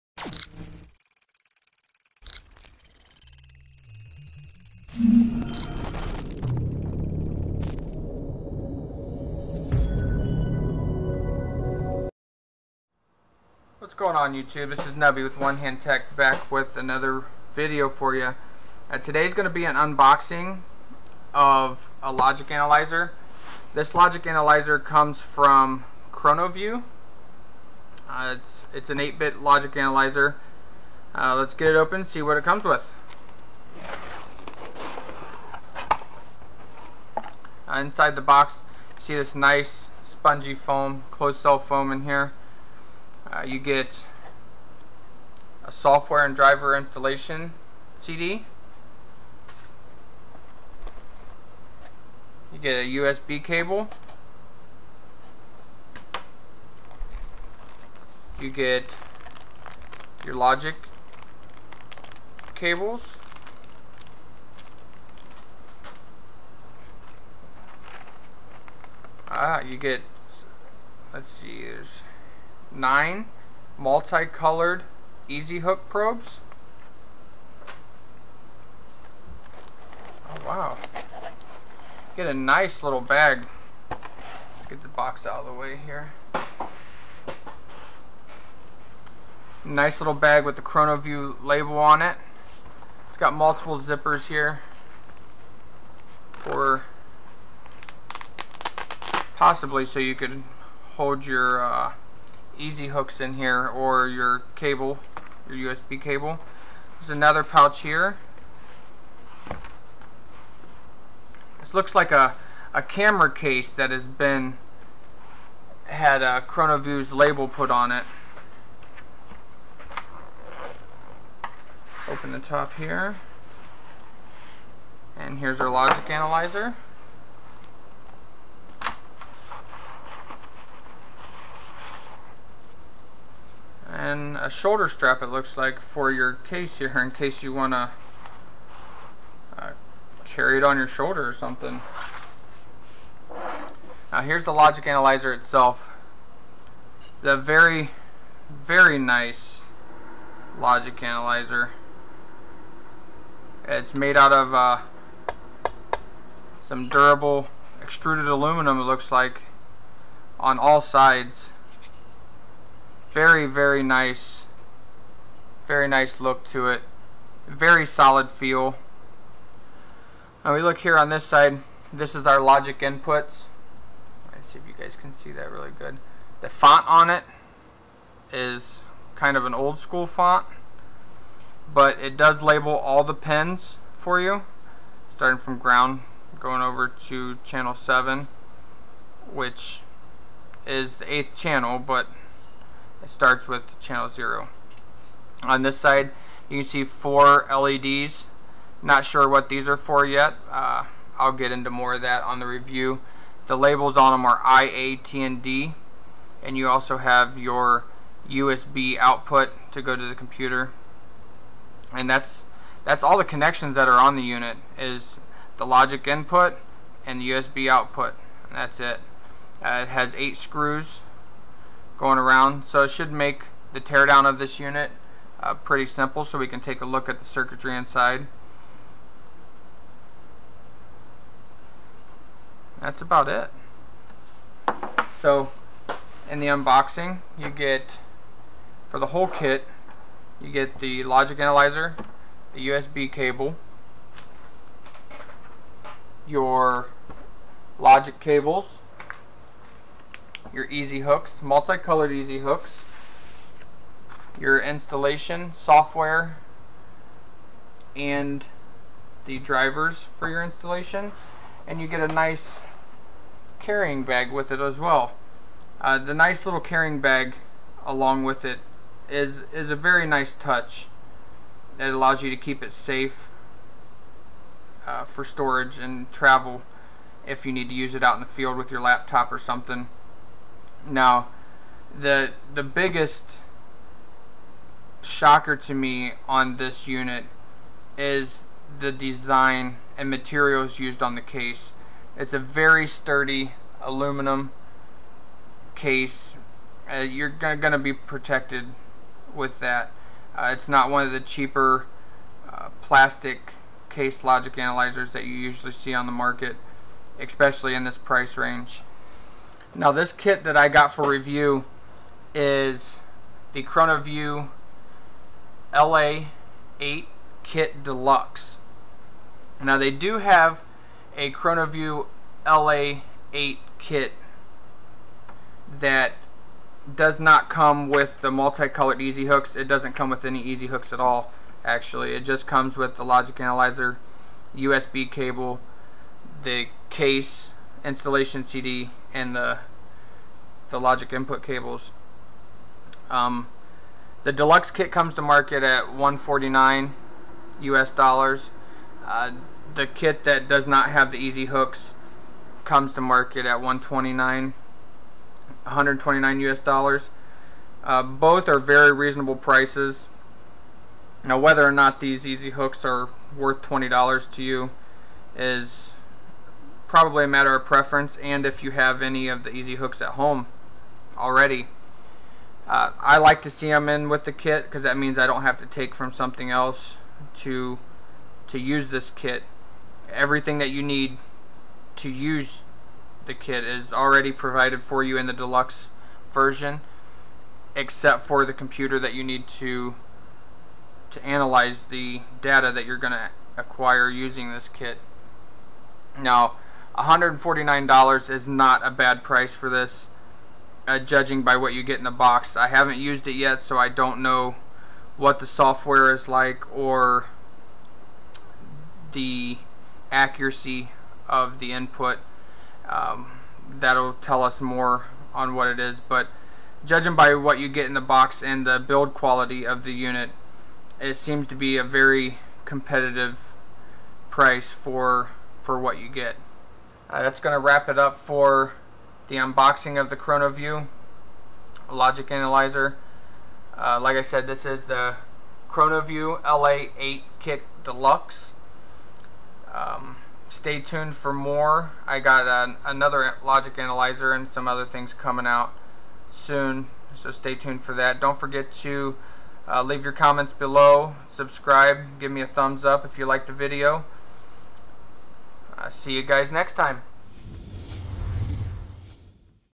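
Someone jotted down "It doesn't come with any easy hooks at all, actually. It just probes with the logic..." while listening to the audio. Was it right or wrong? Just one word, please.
wrong.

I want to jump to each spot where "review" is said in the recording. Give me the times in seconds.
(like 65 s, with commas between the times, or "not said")
202 s, 311 s.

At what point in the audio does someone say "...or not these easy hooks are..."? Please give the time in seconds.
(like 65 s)
361 s.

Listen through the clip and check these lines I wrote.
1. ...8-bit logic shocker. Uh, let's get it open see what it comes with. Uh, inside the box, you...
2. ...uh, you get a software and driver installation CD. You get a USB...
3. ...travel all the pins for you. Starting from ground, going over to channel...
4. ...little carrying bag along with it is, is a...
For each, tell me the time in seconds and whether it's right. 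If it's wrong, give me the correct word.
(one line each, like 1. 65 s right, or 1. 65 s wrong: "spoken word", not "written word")
1. 28 s wrong: "analyzer", not "shocker"
2. 43 s right
3. 182 s wrong: "label", not "travel"
4. 266 s right.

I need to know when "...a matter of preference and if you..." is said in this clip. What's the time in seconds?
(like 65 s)
367 s.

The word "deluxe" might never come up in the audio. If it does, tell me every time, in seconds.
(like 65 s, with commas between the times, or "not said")
317 s, 344 s, 385 s, 437 s.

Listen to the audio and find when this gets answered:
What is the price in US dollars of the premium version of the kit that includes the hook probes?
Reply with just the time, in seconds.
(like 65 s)
345 s.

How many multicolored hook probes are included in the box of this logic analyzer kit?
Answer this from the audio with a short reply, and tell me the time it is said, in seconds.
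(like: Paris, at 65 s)
9, at 72 s.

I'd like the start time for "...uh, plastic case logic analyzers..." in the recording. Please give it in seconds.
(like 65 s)
302 s.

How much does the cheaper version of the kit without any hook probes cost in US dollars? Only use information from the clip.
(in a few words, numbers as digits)
$129.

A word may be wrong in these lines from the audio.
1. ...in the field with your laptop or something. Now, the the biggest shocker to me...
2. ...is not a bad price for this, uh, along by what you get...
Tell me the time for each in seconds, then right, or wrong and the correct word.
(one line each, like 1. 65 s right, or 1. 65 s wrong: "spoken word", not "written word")
1. 278 s right
2. 398 s wrong: "judging", not "along".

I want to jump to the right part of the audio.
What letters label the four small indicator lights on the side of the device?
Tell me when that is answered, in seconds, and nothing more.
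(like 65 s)
204 s.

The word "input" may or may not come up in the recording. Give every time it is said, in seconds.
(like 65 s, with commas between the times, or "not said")
172 s, 216 s, 341 s, 411 s.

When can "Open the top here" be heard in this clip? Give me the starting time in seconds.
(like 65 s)
122 s.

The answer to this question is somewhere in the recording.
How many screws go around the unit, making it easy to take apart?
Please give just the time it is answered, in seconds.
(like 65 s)
220 s.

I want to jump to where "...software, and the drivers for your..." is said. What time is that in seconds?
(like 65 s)
255 s.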